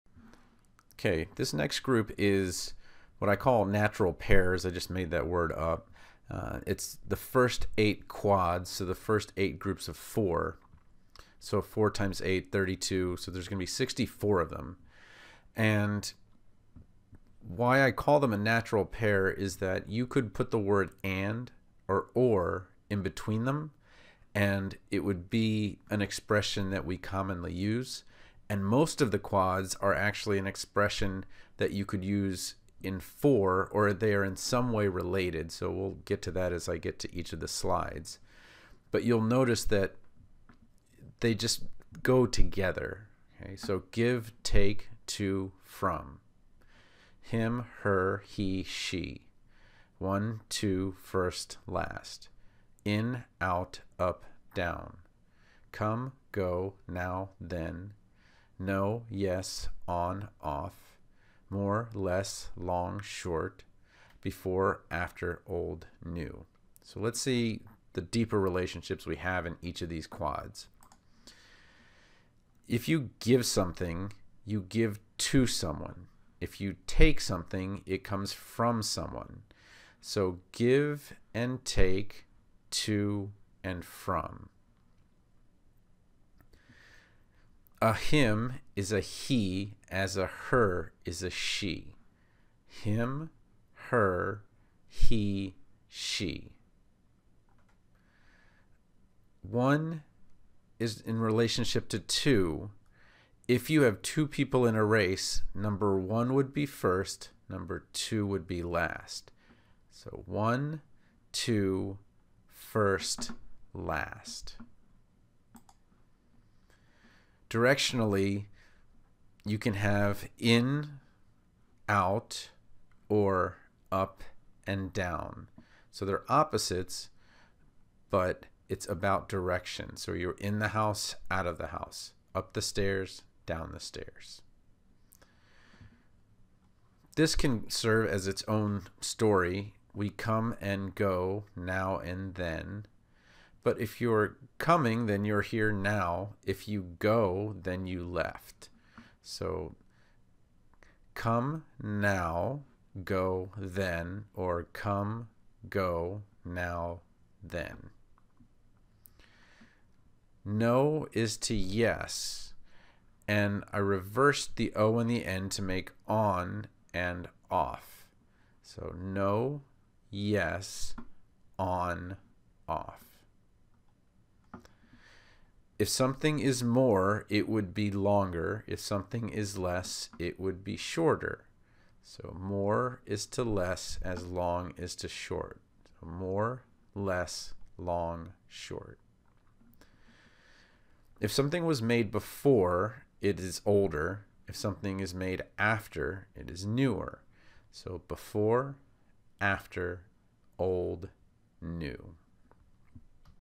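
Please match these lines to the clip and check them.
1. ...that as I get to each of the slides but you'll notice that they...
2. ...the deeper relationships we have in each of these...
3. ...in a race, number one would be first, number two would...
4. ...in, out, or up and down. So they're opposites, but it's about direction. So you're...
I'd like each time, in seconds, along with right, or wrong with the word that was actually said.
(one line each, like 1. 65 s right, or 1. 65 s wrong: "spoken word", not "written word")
1. 36 s right
2. 67 s right
3. 104 s right
4. 120 s right.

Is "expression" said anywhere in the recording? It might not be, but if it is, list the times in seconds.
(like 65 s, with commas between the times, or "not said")
26 s, 30 s.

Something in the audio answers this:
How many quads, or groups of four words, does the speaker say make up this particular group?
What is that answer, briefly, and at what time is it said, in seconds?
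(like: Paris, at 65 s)
8, at 7 s.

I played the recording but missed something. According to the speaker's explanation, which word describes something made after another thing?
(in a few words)
newer.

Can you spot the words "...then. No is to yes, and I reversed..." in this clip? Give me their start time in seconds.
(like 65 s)
157 s.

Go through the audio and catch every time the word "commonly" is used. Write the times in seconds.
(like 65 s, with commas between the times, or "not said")
26 s.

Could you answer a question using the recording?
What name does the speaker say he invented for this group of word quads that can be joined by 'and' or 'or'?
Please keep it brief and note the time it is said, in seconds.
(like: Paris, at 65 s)
natural pairs, at 3 s.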